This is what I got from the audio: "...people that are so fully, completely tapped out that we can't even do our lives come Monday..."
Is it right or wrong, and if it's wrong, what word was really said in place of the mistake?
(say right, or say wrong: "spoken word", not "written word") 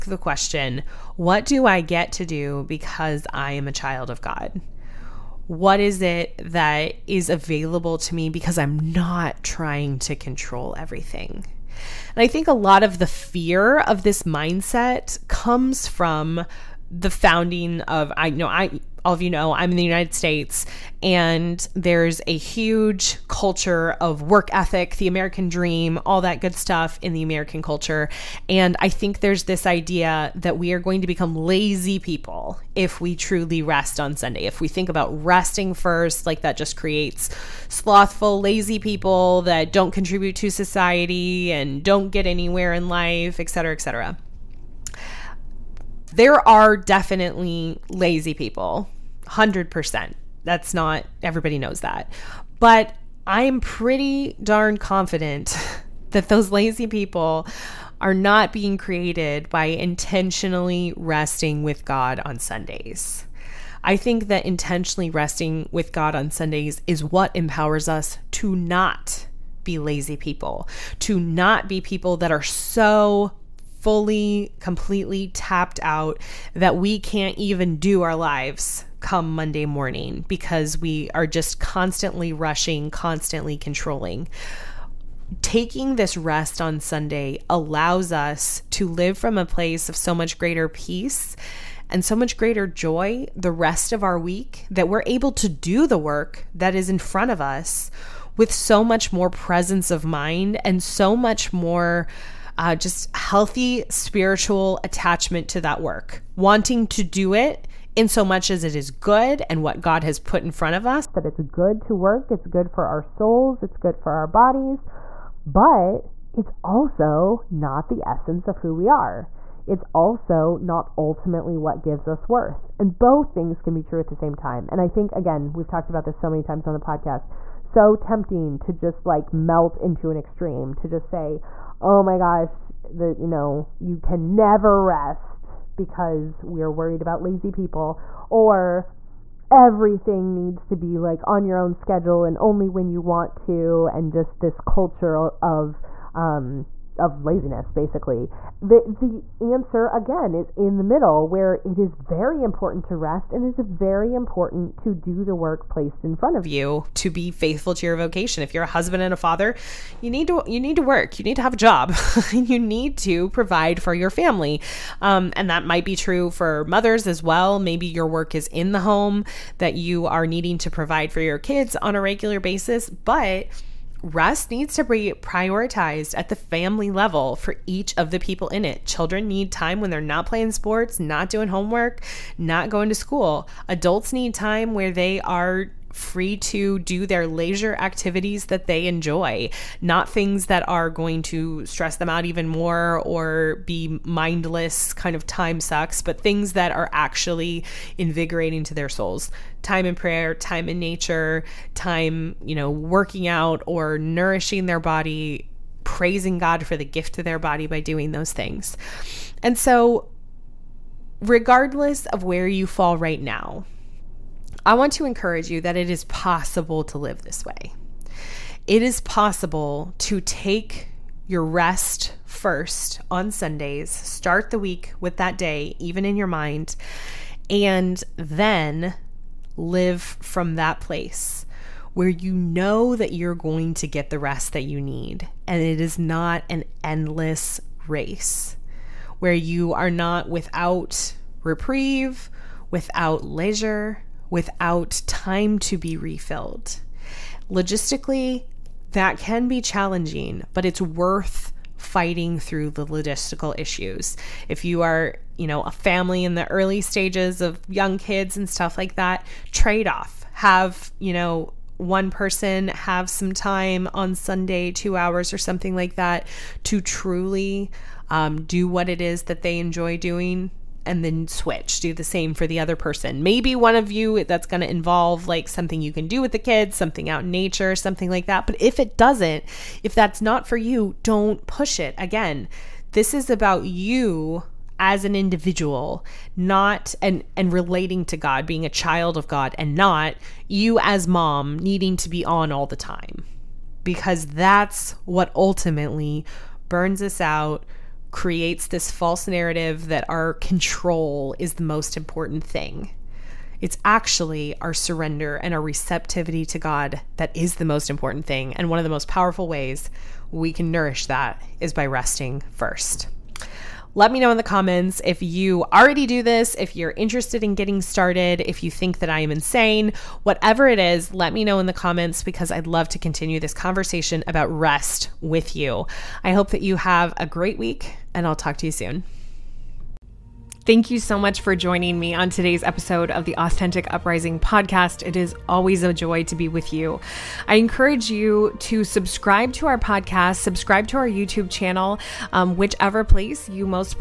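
right.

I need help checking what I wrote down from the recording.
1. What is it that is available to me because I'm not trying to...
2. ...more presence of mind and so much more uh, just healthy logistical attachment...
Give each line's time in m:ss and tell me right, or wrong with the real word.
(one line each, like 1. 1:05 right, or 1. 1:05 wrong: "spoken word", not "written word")
1. 0:05 right
2. 1:39 wrong: "spiritual", not "logistical".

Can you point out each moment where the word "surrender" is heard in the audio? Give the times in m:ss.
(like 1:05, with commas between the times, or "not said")
5:04.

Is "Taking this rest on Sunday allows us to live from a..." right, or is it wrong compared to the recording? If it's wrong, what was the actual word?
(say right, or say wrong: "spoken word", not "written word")
right.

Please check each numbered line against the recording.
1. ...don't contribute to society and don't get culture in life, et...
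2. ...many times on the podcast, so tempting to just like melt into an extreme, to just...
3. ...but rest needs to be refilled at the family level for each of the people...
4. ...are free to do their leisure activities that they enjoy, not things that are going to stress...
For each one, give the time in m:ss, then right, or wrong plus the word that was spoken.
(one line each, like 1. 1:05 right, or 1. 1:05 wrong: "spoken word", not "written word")
1. 0:39 wrong: "anywhere", not "culture"
2. 2:06 right
3. 2:52 wrong: "prioritized", not "refilled"
4. 3:05 right.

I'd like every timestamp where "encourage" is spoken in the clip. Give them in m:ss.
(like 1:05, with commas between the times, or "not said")
3:35, 5:37.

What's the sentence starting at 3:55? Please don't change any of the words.
And it is not an endless race where you are not without reprieve, without leisure, without time to be refilled.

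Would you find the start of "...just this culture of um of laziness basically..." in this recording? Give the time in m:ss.
2:24.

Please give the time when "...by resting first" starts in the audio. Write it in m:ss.
5:11.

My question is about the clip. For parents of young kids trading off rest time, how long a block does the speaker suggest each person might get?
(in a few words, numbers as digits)
2 hours.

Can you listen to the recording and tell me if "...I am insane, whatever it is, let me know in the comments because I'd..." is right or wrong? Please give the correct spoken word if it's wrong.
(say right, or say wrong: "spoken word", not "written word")
right.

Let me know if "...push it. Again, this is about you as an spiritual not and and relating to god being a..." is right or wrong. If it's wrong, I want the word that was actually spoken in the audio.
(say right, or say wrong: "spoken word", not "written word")
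wrong: "individual", not "spiritual".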